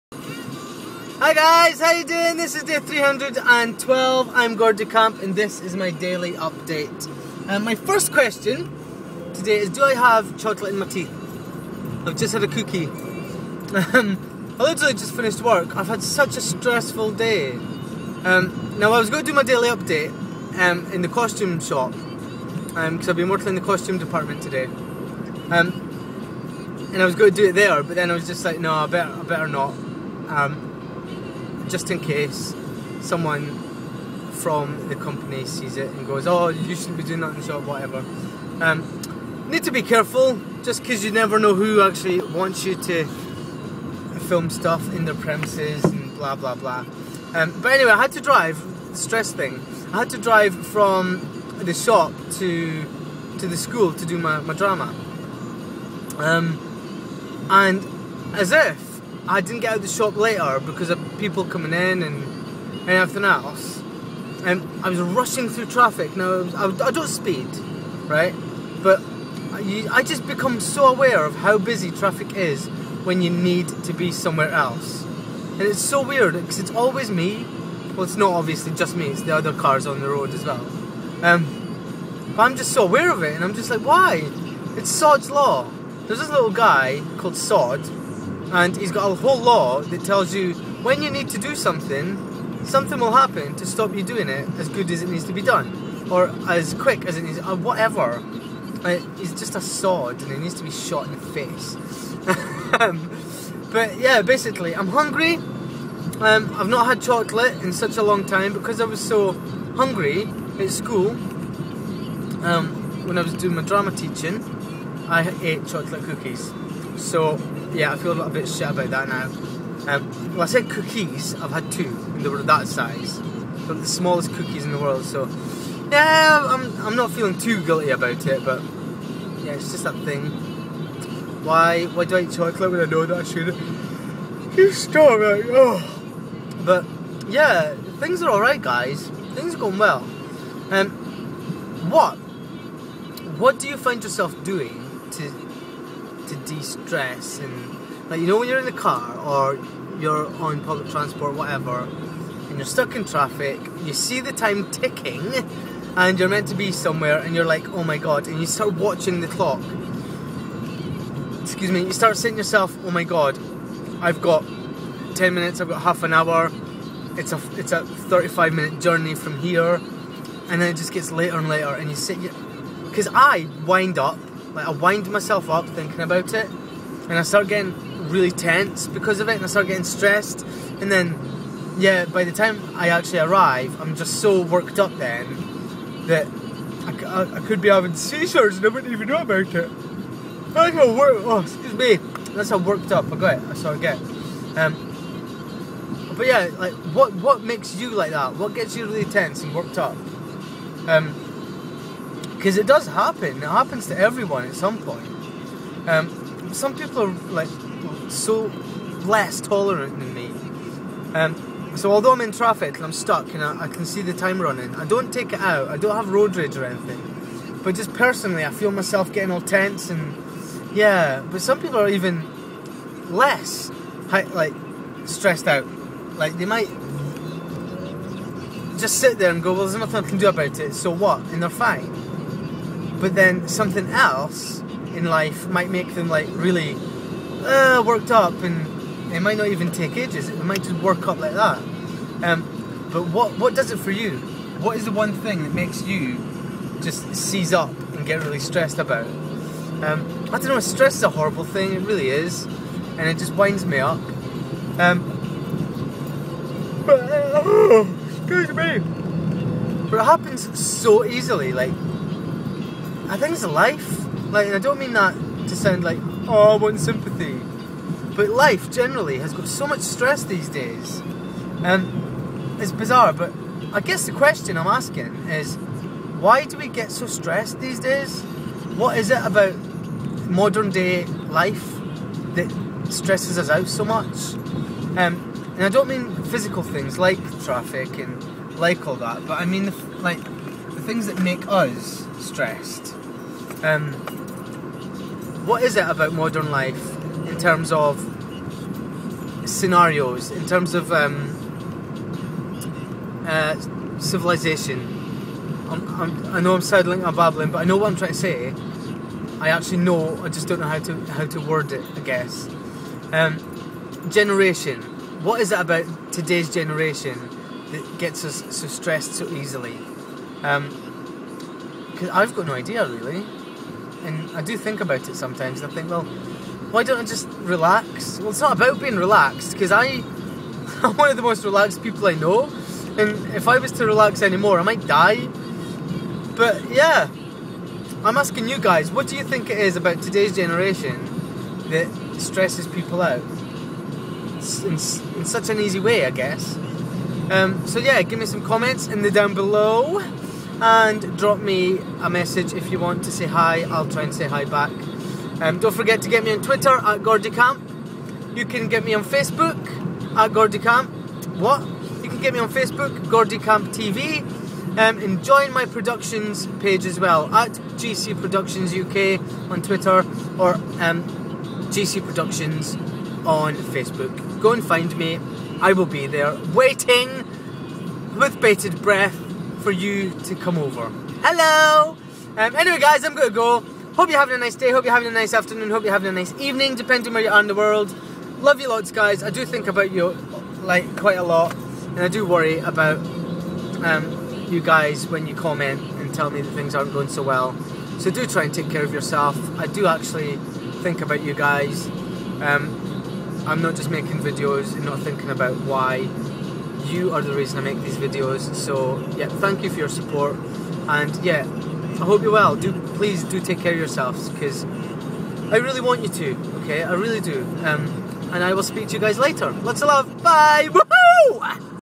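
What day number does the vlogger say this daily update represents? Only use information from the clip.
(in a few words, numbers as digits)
312.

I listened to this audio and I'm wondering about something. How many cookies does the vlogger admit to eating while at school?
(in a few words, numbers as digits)
2.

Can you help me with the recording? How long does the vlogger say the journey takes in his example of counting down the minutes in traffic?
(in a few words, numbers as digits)
35 minutes.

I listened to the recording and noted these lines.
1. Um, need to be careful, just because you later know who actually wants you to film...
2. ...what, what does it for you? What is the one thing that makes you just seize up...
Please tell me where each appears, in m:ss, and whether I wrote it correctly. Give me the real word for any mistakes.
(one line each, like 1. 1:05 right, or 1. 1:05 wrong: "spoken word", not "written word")
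1. 0:38 wrong: "never", not "later"
2. 4:03 right.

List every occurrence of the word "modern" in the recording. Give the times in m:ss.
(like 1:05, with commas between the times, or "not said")
4:40, 4:56.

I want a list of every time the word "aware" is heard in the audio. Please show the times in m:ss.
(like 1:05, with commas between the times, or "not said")
1:10, 1:22.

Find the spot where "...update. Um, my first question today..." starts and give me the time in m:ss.
0:06.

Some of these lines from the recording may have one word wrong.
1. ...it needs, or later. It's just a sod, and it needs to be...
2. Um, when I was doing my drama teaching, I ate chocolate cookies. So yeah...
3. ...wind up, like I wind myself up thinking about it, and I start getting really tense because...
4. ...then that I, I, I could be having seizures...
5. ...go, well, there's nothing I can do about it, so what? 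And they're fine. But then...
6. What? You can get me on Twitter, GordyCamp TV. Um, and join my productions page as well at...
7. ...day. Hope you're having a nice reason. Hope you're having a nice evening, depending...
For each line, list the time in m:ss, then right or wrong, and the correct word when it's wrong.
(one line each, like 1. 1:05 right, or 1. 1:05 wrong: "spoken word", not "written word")
1. 1:37 wrong: "whatever", not "later"
2. 1:52 right
3. 2:53 right
4. 3:04 right
5. 3:49 right
6. 6:01 wrong: "Facebook", not "Twitter"
7. 6:24 wrong: "afternoon", not "reason".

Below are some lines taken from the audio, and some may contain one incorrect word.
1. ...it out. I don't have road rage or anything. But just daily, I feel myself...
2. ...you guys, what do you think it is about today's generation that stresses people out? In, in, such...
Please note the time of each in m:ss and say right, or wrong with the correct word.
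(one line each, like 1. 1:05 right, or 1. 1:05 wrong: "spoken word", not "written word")
1. 3:35 wrong: "personally", not "daily"
2. 5:38 right.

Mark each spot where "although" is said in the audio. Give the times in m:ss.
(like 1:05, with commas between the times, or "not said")
3:31.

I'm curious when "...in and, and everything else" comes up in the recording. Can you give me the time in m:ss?
1:01.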